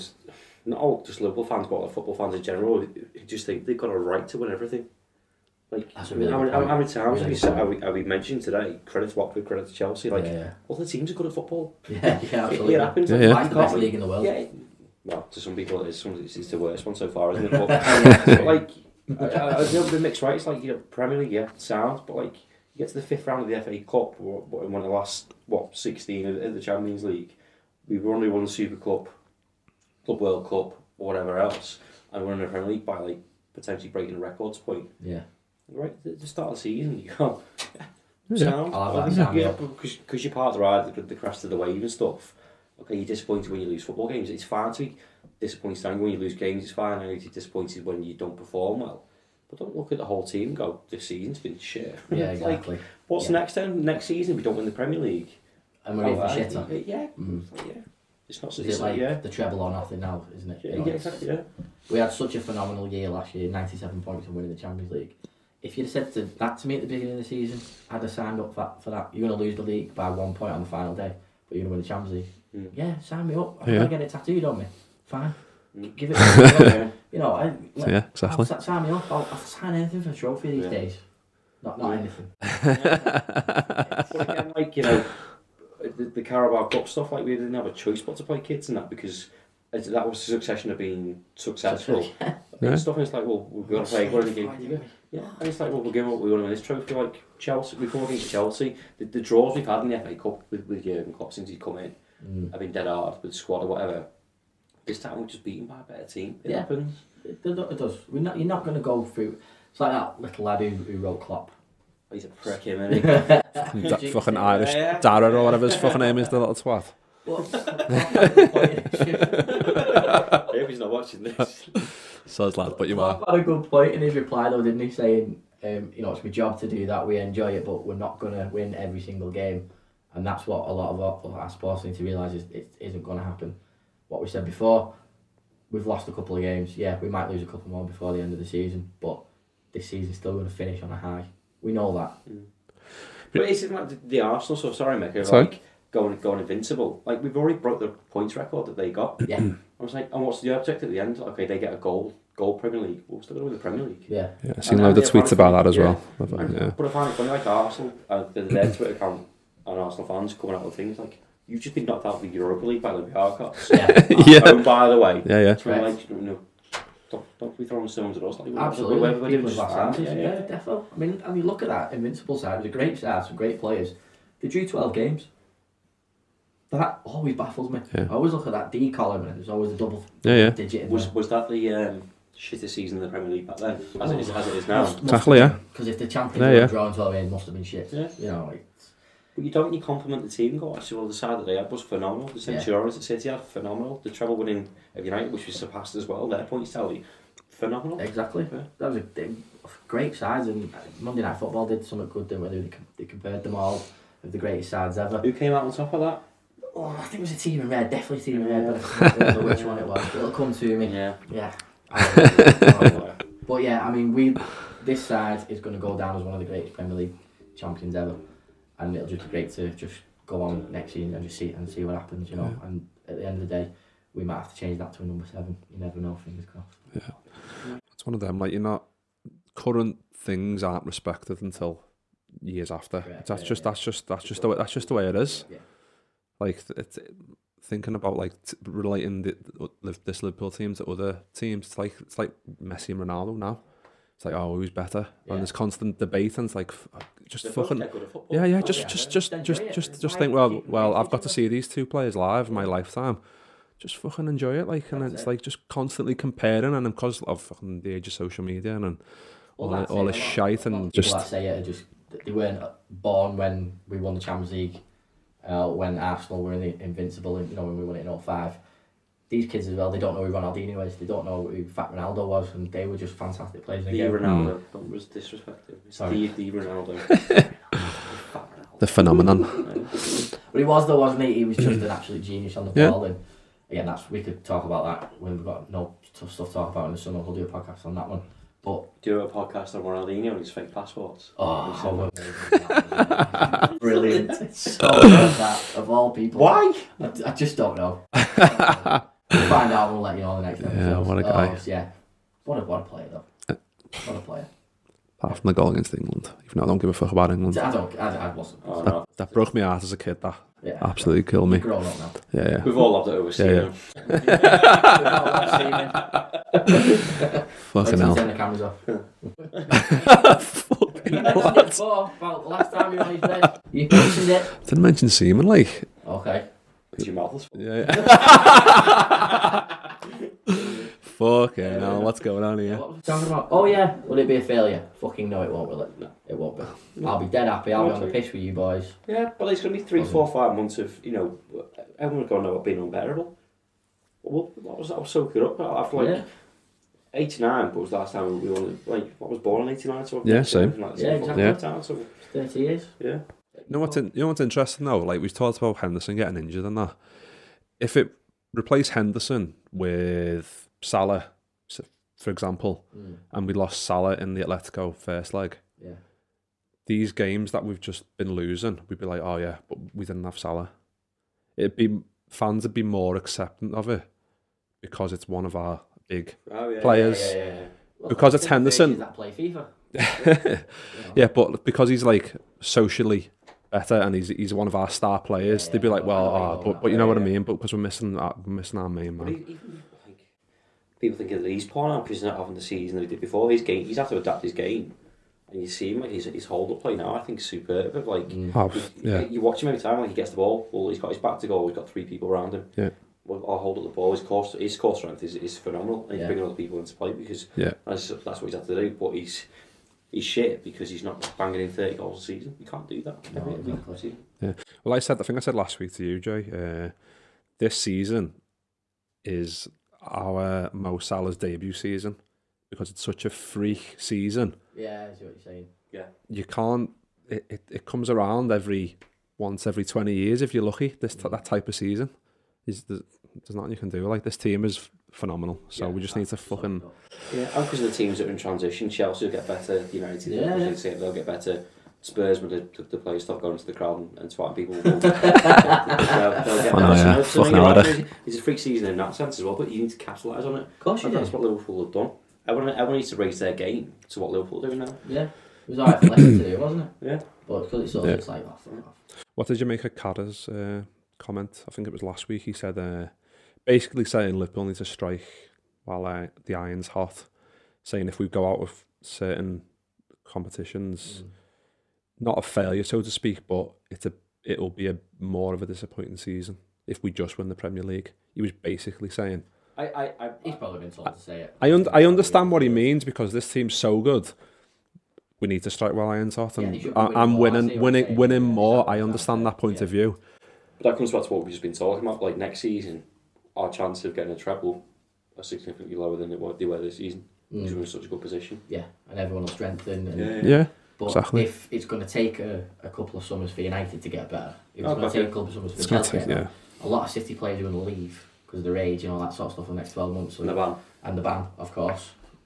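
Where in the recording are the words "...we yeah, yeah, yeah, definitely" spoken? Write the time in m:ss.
2:49.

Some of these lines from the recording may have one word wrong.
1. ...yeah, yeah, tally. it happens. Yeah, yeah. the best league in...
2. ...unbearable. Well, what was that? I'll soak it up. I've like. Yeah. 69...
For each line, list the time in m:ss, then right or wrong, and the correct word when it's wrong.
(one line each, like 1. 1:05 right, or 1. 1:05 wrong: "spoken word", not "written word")
1. 0:11 wrong: "absolutely", not "tally"
2. 5:42 wrong: "89", not "69".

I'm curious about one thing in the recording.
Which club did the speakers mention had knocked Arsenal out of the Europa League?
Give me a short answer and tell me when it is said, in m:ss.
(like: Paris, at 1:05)
Olympiacos, at 2:43.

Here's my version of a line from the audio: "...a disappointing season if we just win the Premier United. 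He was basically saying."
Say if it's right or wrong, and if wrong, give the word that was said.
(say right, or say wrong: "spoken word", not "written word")
wrong: "League", not "United".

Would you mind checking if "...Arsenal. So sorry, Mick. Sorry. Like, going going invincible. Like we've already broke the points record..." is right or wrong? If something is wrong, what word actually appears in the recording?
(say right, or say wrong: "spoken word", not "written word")
right.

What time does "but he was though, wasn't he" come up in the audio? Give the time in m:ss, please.
4:40.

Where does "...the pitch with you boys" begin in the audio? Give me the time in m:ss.
5:37.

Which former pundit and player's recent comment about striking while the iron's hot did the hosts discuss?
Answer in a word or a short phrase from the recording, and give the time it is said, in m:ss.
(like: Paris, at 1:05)
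Carragher, at 7:39.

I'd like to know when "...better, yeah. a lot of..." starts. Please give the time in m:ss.
8:26.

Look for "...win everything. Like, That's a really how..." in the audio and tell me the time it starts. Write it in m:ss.
0:04.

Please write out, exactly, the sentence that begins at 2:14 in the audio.
What we said before, we've lost a couple of games.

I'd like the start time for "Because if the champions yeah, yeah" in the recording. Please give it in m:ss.
3:05.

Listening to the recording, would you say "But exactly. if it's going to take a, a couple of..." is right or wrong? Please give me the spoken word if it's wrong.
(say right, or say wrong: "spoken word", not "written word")
right.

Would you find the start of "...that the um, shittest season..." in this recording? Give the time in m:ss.
3:01.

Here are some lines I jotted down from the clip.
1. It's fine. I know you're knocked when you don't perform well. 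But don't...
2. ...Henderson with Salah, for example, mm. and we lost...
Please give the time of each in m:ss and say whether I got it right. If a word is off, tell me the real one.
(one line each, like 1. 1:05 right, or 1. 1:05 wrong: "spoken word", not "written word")
1. 0:46 wrong: "disappointed", not "knocked"
2. 5:58 right.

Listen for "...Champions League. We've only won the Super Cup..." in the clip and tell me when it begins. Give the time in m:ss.
0:26.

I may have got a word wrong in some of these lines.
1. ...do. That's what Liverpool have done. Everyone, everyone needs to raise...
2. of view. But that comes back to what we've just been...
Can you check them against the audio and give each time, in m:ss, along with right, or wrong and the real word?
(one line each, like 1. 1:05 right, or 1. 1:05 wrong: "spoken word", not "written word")
1. 7:31 right
2. 8:09 right.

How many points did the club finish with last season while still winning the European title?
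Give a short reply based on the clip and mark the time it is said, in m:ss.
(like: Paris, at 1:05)
97, at 1:03.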